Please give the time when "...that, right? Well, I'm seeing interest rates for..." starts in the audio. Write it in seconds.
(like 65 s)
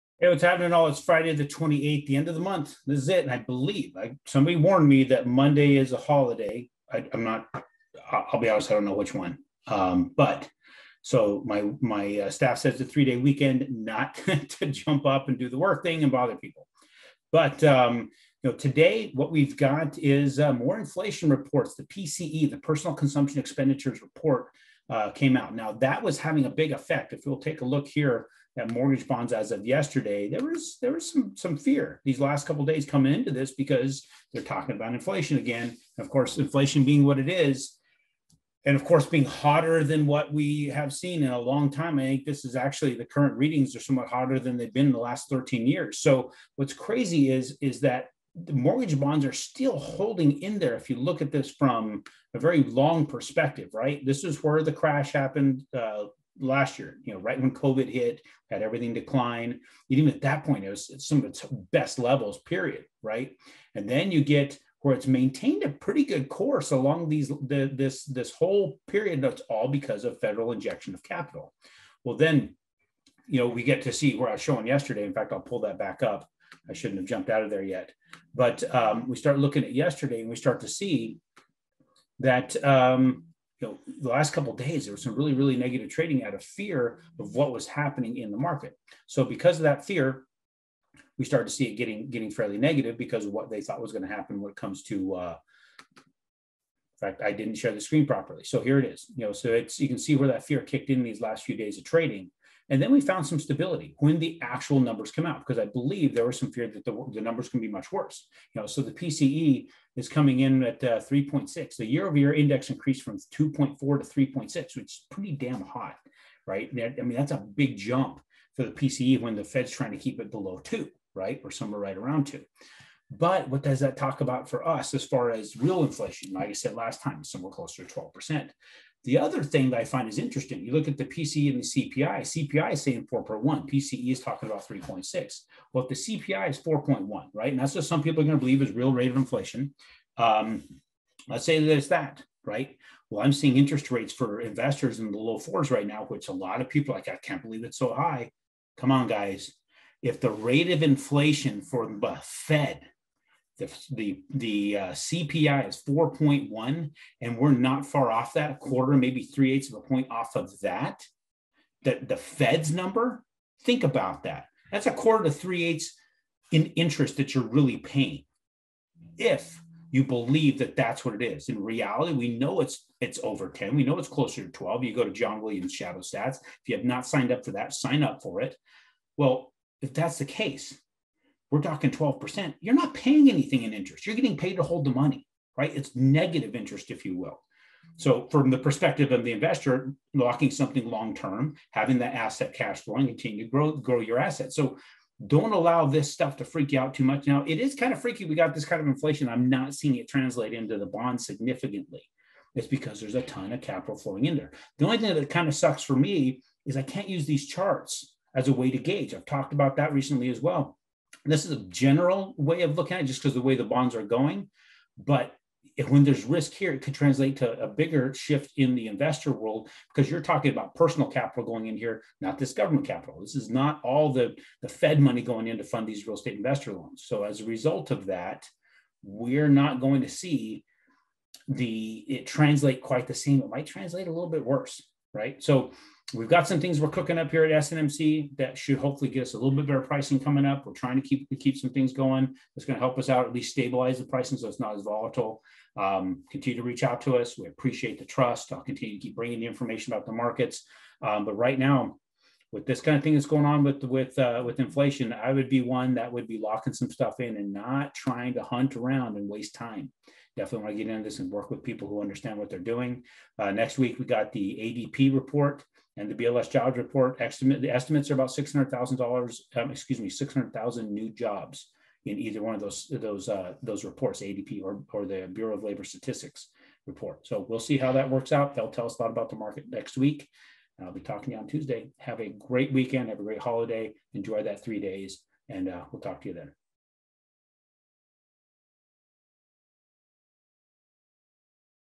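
141 s.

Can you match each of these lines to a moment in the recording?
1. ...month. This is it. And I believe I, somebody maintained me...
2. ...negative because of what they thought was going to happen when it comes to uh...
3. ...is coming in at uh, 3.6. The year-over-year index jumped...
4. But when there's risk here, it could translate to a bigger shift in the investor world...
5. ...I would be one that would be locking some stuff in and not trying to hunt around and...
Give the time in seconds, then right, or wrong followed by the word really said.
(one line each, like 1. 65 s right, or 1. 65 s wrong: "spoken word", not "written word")
1. 2 s wrong: "warned", not "maintained"
2. 92 s right
3. 109 s wrong: "increased", not "jumped"
4. 214 s right
5. 255 s right.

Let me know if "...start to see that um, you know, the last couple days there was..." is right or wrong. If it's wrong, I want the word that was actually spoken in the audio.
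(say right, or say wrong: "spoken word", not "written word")
right.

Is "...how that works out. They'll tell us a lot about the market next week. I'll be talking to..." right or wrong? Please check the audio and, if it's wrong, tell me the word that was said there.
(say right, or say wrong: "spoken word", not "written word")
right.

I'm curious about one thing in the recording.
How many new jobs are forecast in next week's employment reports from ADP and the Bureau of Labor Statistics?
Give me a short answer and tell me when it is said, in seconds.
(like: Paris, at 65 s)
600,000, at 270 s.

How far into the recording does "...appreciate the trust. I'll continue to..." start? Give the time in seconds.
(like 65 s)
247 s.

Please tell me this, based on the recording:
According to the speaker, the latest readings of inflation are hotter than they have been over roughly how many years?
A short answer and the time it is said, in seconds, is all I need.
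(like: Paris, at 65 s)
13, at 45 s.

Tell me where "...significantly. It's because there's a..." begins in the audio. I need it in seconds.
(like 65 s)
201 s.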